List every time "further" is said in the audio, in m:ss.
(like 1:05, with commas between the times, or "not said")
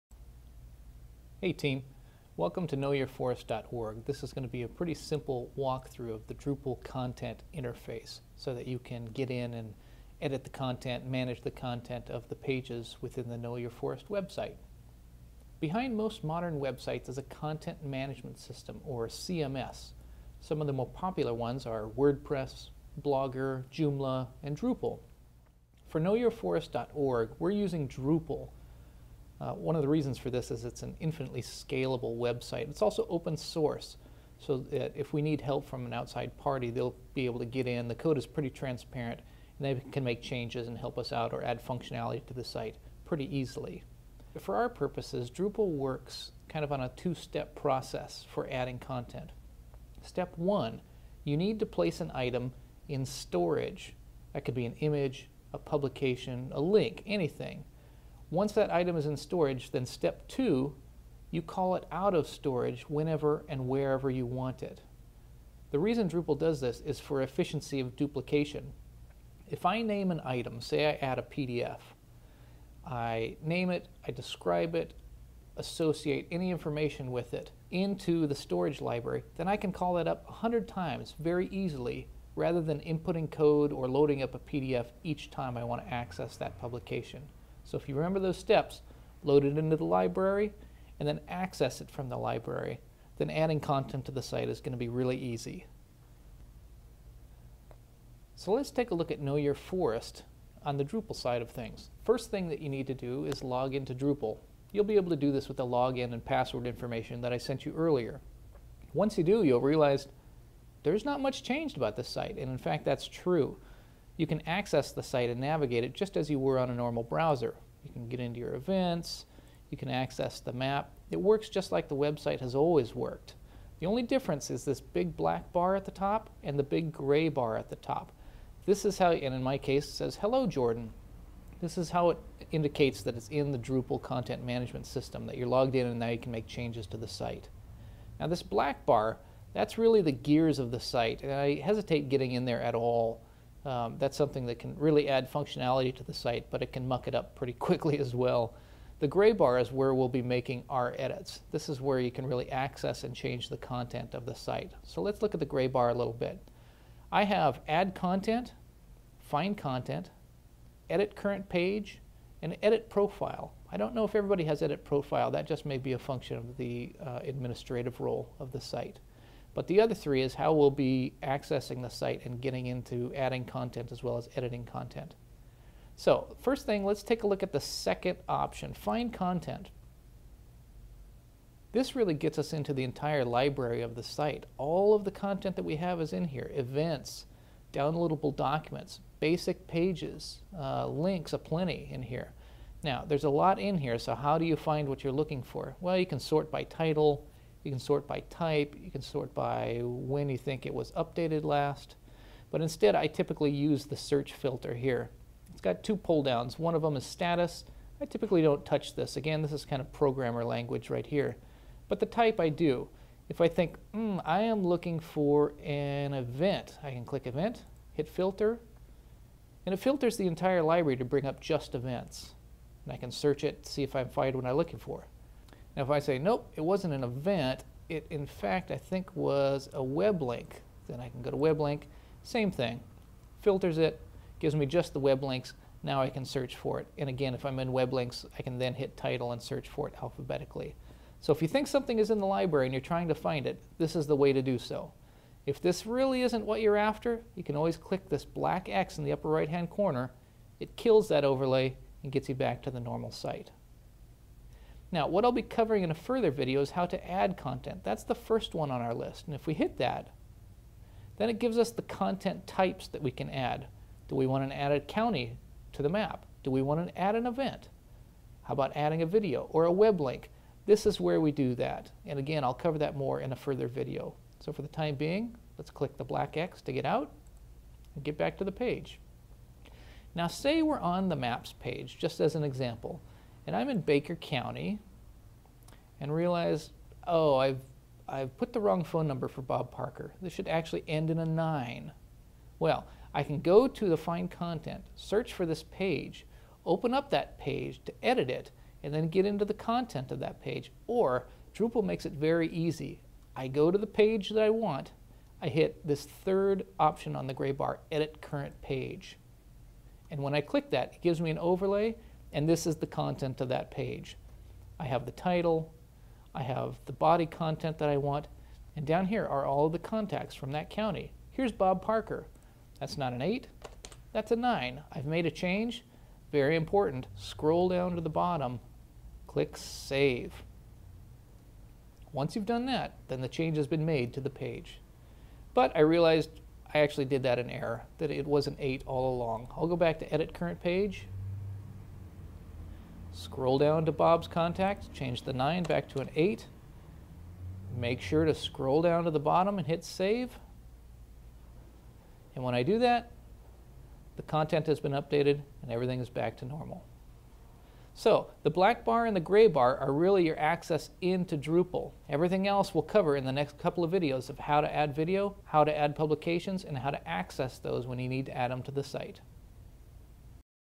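4:15, 4:33.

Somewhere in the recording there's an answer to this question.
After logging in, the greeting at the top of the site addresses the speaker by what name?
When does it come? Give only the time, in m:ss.
2:10.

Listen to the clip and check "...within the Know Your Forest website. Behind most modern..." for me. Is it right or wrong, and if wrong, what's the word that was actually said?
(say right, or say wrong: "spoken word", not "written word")
right.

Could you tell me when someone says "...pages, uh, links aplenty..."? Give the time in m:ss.
3:09.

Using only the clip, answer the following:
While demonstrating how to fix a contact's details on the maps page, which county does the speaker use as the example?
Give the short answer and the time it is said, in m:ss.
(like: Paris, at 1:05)
Baker County, at 4:43.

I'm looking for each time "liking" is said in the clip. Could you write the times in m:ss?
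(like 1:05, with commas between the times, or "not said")
not said.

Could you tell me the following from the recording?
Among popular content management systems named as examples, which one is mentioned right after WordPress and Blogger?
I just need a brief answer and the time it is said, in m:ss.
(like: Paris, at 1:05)
Joomla, at 0:23.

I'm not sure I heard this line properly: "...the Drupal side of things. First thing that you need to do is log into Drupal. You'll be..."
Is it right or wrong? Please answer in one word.
right.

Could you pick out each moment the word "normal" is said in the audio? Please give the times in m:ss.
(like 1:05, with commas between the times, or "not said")
1:56, 4:12, 5:56.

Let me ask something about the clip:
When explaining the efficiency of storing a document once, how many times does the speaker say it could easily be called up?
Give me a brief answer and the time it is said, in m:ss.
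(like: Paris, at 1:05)
100, at 1:20.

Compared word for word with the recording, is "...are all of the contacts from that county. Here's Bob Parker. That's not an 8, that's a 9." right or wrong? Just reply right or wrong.
right.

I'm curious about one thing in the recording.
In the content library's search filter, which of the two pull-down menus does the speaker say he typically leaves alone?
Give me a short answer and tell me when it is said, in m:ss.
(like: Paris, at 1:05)
status, at 3:27.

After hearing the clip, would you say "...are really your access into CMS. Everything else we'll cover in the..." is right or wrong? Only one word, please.
wrong.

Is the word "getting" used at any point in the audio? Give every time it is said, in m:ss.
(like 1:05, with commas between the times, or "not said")
2:22, 2:52.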